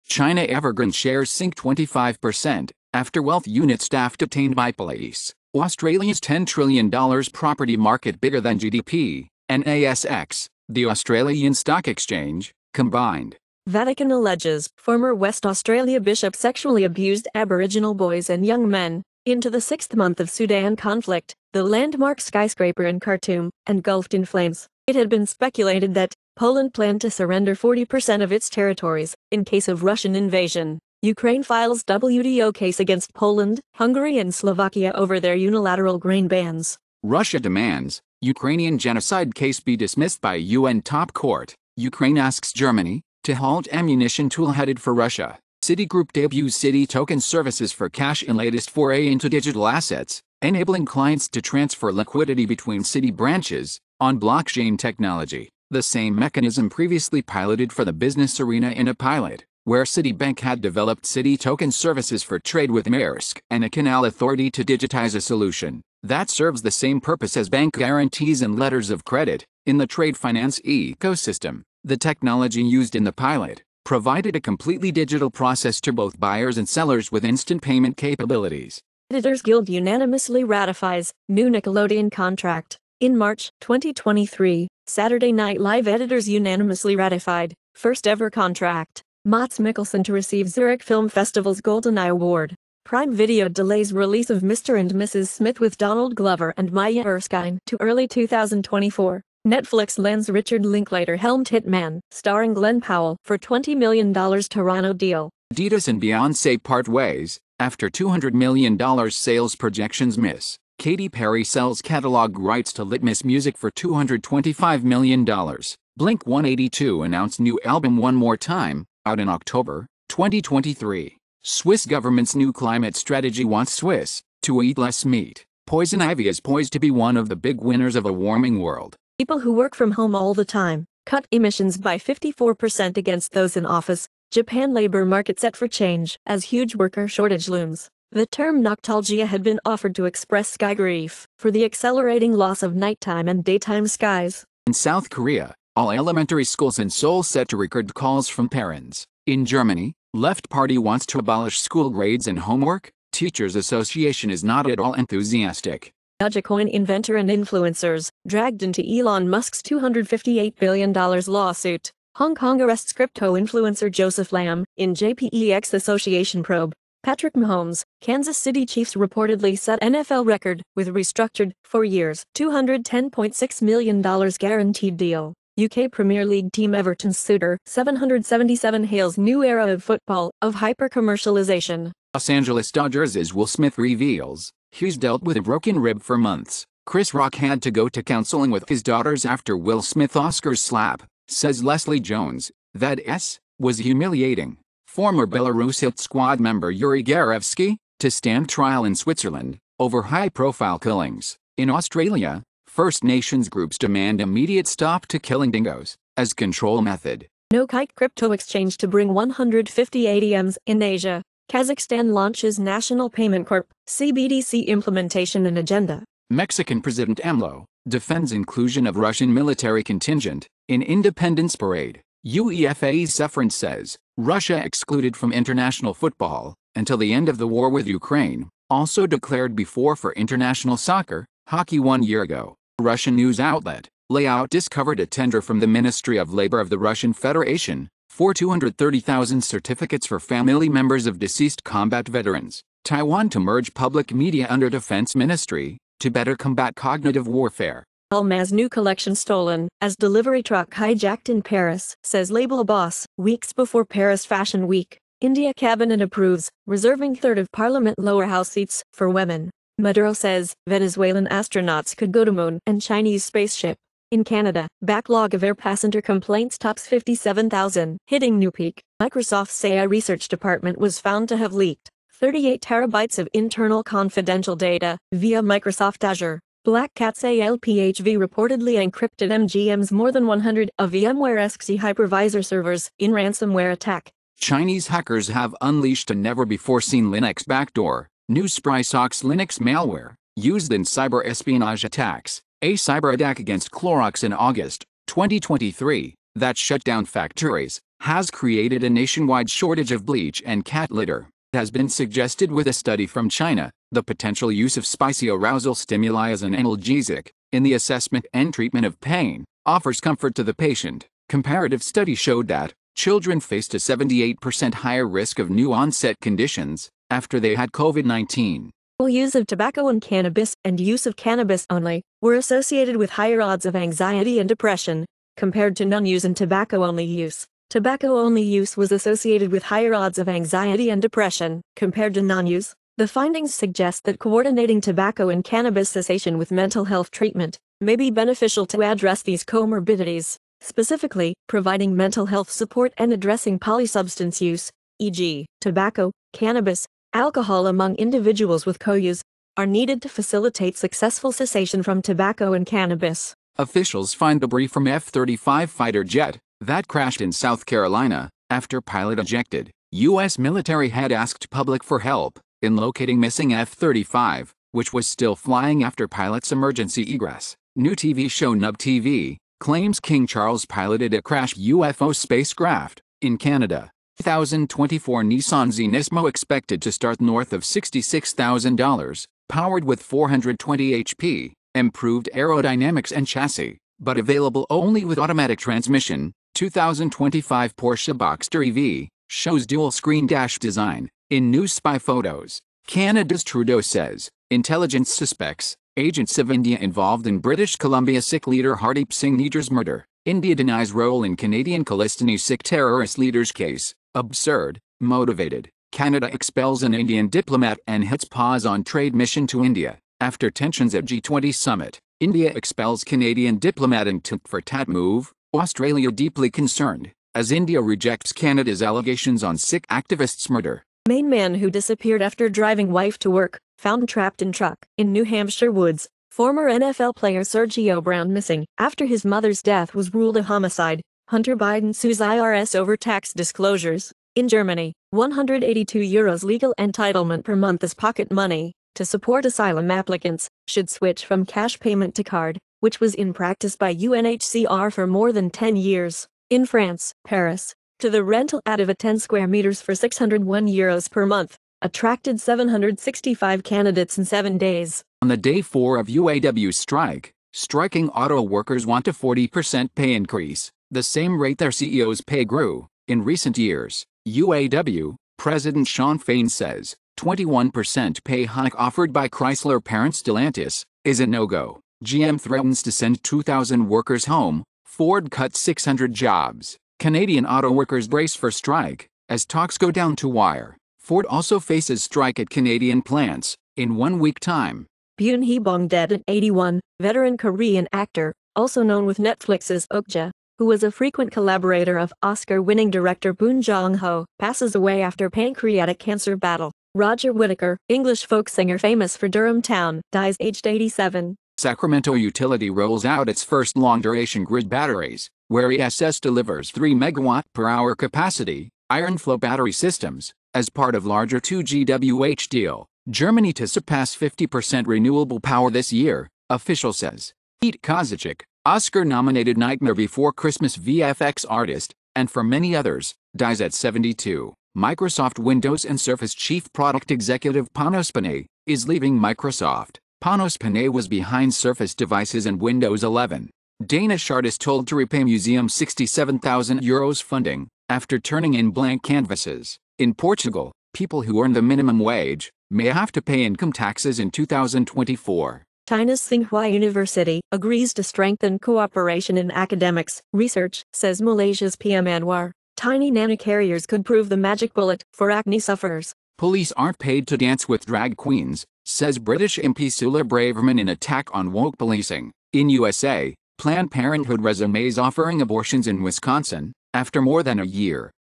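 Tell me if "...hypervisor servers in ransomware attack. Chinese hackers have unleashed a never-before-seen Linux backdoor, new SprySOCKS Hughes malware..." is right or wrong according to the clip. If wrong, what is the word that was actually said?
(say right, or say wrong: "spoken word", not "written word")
wrong: "Linux", not "Hughes".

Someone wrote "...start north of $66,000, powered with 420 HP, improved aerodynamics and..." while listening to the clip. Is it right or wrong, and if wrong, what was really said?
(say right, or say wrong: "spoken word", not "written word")
right.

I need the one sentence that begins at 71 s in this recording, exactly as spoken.
The technology used in the pilot provided a completely digital process to both buyers and sellers with instant payment capabilities.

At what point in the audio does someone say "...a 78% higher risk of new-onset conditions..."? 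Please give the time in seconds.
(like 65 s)
313 s.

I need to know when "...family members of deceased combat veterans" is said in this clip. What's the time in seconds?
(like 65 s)
240 s.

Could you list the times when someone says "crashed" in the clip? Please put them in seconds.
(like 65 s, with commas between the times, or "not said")
356 s, 371 s.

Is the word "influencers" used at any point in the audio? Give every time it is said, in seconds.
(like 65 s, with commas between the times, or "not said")
157 s, 163 s.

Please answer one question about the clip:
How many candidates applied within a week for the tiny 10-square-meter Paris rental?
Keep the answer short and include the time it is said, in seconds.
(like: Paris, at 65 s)
765, at 452 s.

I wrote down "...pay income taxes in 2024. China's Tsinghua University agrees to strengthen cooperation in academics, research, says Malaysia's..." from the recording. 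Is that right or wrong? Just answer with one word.
right.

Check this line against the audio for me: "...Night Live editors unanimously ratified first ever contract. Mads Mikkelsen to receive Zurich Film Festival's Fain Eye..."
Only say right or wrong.
wrong.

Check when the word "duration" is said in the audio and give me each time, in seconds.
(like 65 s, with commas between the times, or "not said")
503 s.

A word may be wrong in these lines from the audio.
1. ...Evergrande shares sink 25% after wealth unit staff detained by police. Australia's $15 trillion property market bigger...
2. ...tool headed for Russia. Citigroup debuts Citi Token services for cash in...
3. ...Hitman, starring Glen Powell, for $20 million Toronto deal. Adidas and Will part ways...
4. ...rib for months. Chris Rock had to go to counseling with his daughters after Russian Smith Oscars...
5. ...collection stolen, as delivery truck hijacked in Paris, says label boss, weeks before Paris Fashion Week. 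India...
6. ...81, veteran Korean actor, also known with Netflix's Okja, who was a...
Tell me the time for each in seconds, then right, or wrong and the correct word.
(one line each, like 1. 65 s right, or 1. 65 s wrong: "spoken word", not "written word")
1. 0 s wrong: "10", not "15"
2. 44 s right
3. 101 s wrong: "Beyonce", not "Will"
4. 185 s wrong: "Will", not "Russian"
5. 248 s right
6. 486 s right.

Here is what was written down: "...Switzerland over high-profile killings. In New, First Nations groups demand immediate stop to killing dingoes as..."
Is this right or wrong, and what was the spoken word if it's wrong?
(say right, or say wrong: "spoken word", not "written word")
wrong: "Australia", not "New".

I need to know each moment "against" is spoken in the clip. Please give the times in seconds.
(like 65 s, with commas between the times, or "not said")
32 s, 132 s, 293 s.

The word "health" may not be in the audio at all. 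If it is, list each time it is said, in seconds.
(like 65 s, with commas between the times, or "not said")
336 s, 342 s.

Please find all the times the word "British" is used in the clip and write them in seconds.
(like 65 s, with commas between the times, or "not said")
397 s, 559 s.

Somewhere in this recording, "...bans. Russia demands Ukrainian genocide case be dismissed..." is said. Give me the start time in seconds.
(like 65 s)
36 s.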